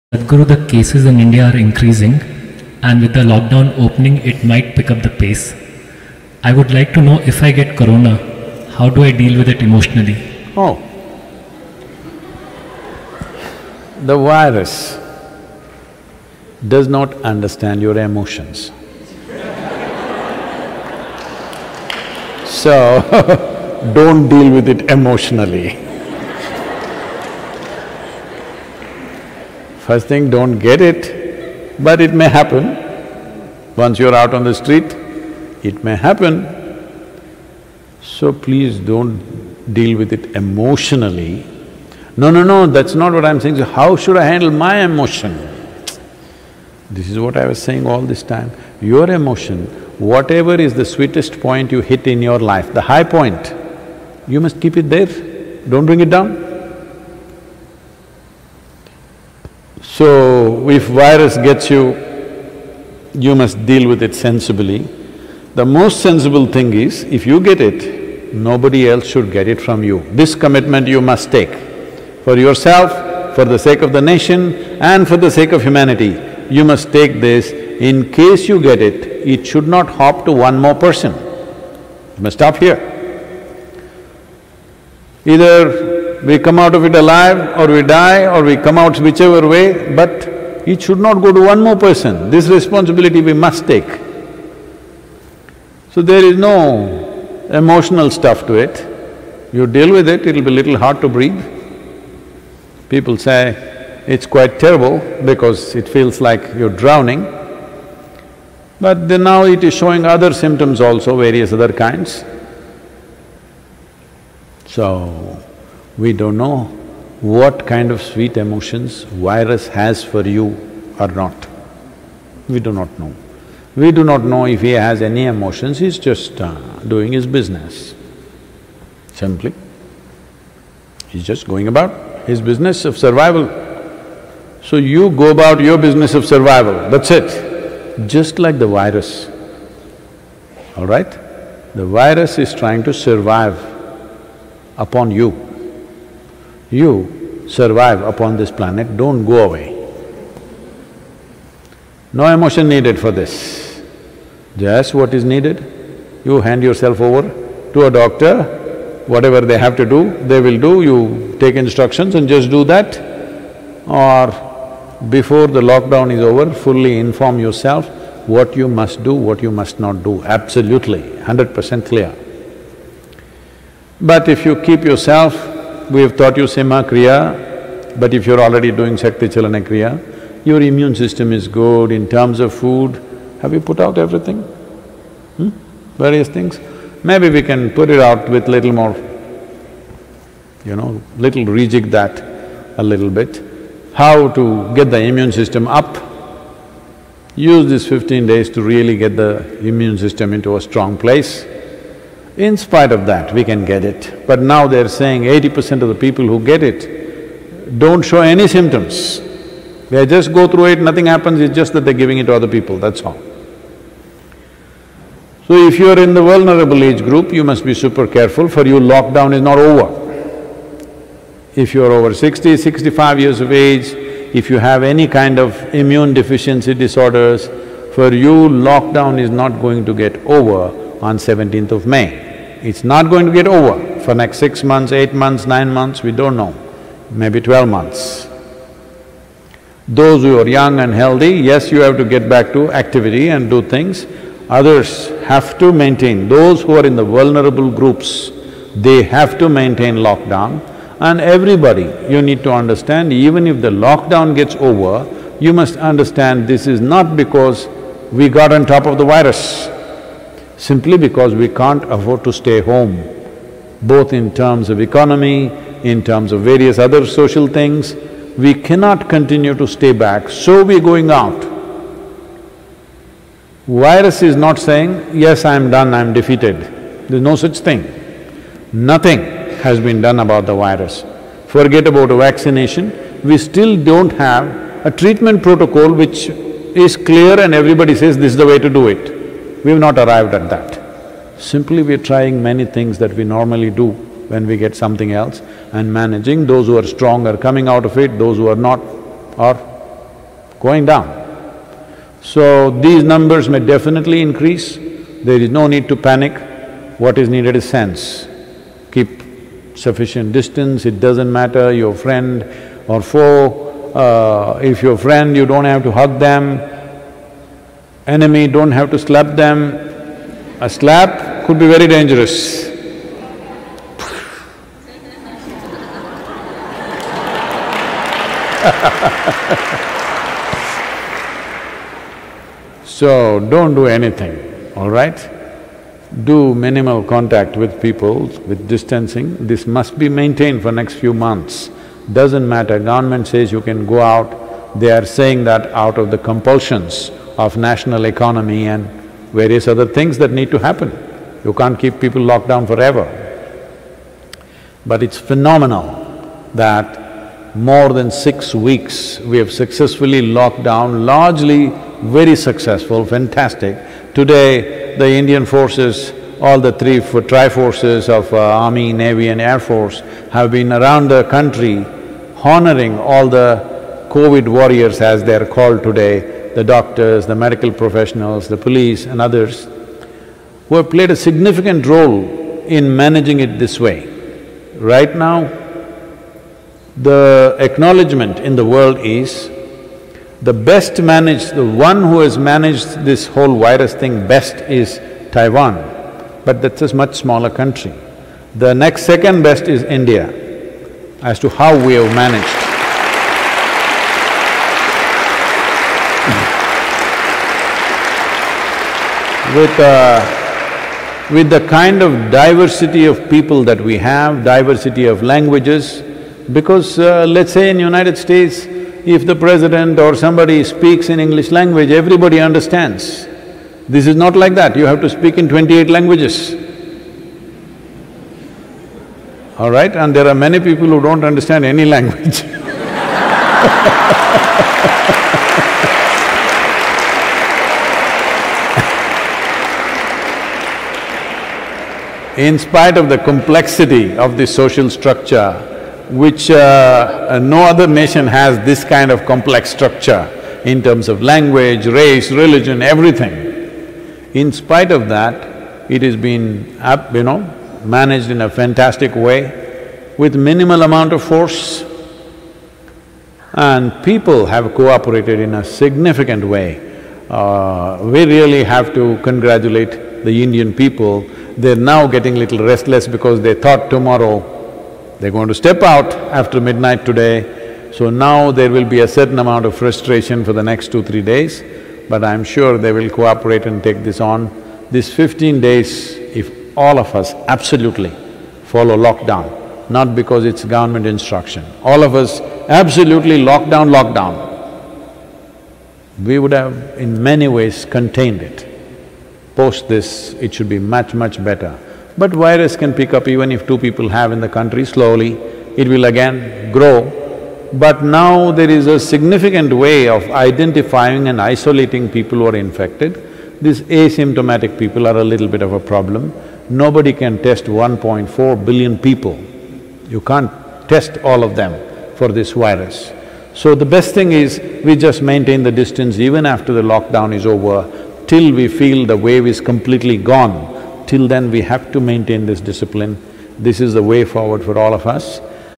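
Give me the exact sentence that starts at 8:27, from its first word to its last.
But now there is a significant way of identifying and isolating people who are infected.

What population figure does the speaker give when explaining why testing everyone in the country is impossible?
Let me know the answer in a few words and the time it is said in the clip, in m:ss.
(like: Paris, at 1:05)
1.4 billion, at 8:37.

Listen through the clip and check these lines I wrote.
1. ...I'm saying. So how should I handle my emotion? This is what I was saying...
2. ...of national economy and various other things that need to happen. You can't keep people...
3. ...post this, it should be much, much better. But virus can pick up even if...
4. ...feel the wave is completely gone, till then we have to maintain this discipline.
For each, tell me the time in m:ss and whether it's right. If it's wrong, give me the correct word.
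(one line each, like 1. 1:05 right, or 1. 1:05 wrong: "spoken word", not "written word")
1. 0:43 right
2. 5:47 right
3. 8:19 right
4. 8:48 right.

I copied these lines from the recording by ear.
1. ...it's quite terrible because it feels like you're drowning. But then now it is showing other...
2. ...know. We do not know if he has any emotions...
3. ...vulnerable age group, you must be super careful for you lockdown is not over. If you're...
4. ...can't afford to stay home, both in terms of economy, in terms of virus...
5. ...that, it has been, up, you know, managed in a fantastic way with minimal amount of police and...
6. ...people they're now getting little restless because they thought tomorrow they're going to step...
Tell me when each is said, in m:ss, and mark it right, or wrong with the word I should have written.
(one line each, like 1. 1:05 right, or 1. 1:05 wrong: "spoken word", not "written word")
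1. 1:44 right
2. 2:02 right
3. 3:36 right
4. 4:21 wrong: "various", not "virus"
5. 7:35 wrong: "force", not "police"
6. 7:50 right.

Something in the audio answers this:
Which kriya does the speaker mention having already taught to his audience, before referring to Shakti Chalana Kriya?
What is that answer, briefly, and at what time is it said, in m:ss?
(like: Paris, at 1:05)
Simha Kriya, at 2:56.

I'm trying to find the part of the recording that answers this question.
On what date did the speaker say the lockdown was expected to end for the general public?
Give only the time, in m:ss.
3:51.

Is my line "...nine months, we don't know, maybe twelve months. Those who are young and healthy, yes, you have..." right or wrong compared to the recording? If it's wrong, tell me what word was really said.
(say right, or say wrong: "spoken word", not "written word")
right.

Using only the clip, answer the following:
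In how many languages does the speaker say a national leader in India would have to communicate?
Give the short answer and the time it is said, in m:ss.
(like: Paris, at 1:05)
28, at 7:05.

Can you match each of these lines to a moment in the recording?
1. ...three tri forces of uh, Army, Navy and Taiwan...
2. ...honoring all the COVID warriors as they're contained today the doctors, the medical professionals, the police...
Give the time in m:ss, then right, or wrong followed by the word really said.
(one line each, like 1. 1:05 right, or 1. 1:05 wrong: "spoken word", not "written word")
1. 6:06 wrong: "Air", not "Taiwan"
2. 6:12 wrong: "called", not "contained".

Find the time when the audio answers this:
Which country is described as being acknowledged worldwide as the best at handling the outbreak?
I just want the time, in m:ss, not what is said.
6:35.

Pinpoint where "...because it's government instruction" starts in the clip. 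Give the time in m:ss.
8:10.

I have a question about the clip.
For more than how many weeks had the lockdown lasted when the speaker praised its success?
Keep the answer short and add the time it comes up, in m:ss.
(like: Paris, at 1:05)
6, at 5:58.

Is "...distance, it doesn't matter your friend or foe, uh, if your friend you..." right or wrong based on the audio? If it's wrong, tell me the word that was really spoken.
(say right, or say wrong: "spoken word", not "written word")
right.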